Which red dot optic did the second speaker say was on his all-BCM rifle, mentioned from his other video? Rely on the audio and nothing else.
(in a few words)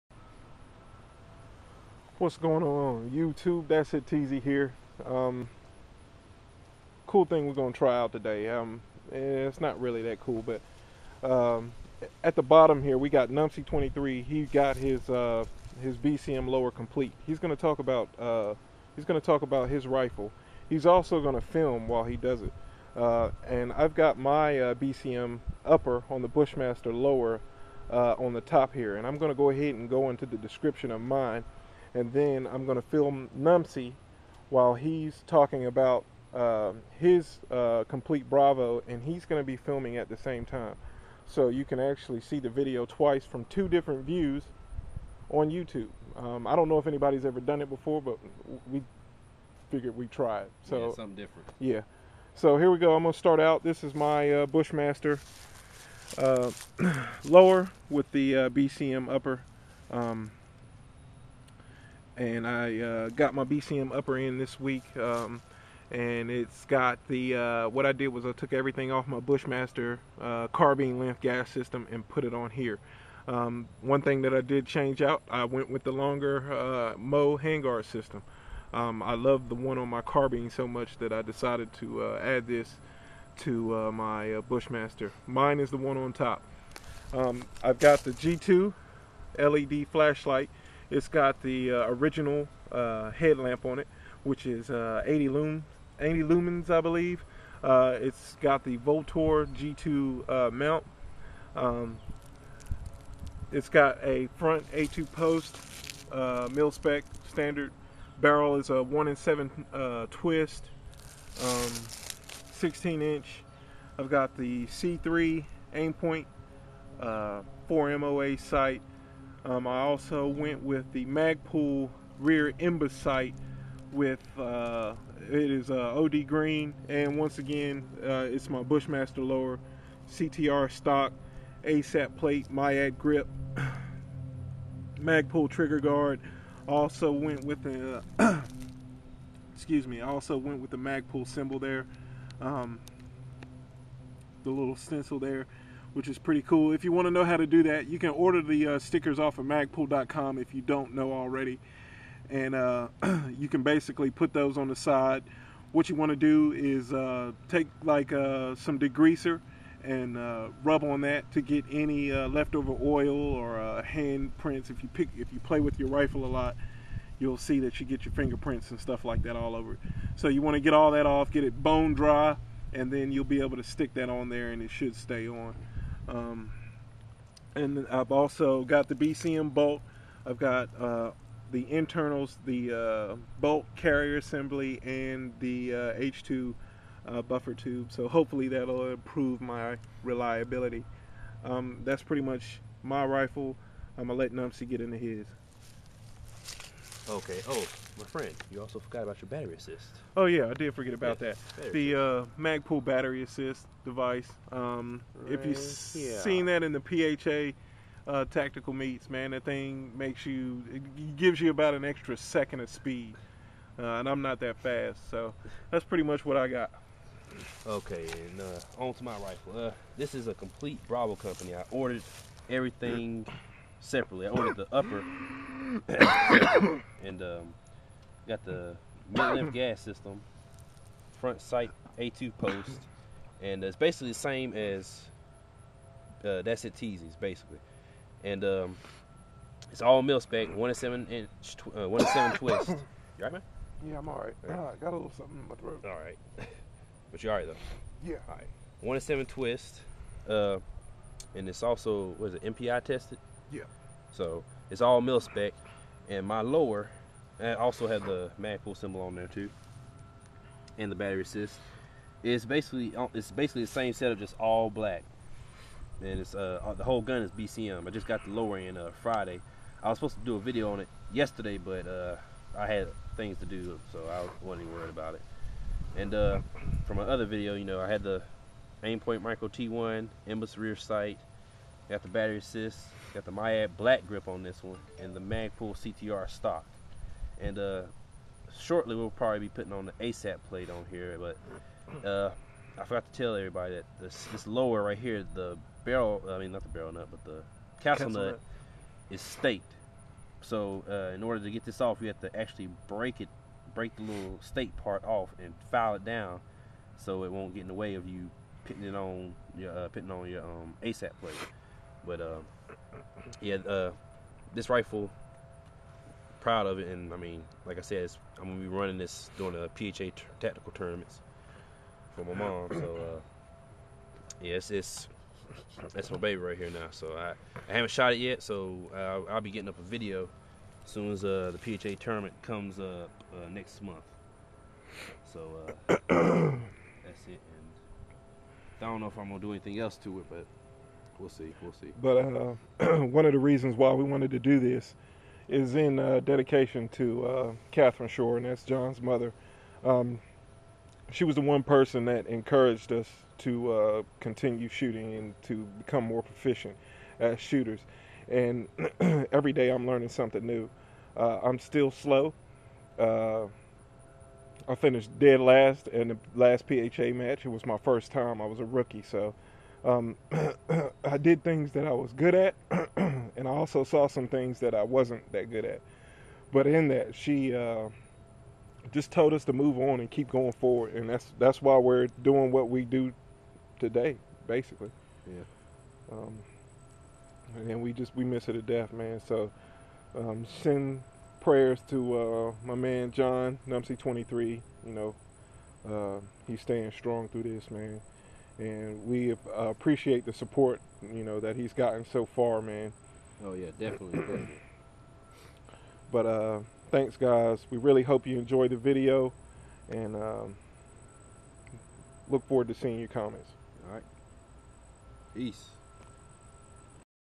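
Aimpoint Micro T1.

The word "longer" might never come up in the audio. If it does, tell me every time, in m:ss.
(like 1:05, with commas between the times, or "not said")
1:15.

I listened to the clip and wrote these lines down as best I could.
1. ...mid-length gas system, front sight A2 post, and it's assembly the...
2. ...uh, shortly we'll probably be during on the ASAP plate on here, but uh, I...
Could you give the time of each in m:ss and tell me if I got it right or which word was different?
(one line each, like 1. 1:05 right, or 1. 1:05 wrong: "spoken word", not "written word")
1. 3:49 wrong: "basically", not "assembly"
2. 4:47 wrong: "putting", not "during".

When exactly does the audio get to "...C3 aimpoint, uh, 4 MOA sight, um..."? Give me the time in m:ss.
1:54.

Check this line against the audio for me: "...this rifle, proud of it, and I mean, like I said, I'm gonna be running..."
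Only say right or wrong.
right.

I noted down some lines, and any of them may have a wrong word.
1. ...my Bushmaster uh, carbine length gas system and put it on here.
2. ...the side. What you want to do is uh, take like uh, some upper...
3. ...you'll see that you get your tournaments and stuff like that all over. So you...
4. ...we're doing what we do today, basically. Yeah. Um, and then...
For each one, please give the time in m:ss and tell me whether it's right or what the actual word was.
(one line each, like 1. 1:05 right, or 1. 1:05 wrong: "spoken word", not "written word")
1. 1:09 right
2. 2:34 wrong: "degreaser", not "upper"
3. 2:47 wrong: "fingerprints", not "tournaments"
4. 6:21 right.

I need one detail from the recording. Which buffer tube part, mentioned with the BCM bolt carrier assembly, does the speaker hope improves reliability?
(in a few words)
H2.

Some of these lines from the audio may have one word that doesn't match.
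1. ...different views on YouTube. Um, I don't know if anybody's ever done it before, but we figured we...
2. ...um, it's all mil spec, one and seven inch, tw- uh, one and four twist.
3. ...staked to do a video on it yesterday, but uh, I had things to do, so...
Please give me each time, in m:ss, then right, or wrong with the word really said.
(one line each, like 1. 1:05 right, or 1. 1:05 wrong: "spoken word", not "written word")
1. 0:43 right
2. 3:58 wrong: "seven", not "four"
3. 4:29 wrong: "supposed", not "staked".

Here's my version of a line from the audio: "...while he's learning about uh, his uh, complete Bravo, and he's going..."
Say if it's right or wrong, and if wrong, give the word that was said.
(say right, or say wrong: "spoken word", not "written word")
wrong: "talking", not "learning".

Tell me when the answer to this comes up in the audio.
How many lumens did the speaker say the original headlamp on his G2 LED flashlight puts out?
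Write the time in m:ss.
1:35.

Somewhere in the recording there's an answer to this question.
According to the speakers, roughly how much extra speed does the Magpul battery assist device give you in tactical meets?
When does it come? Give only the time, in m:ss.
3:31.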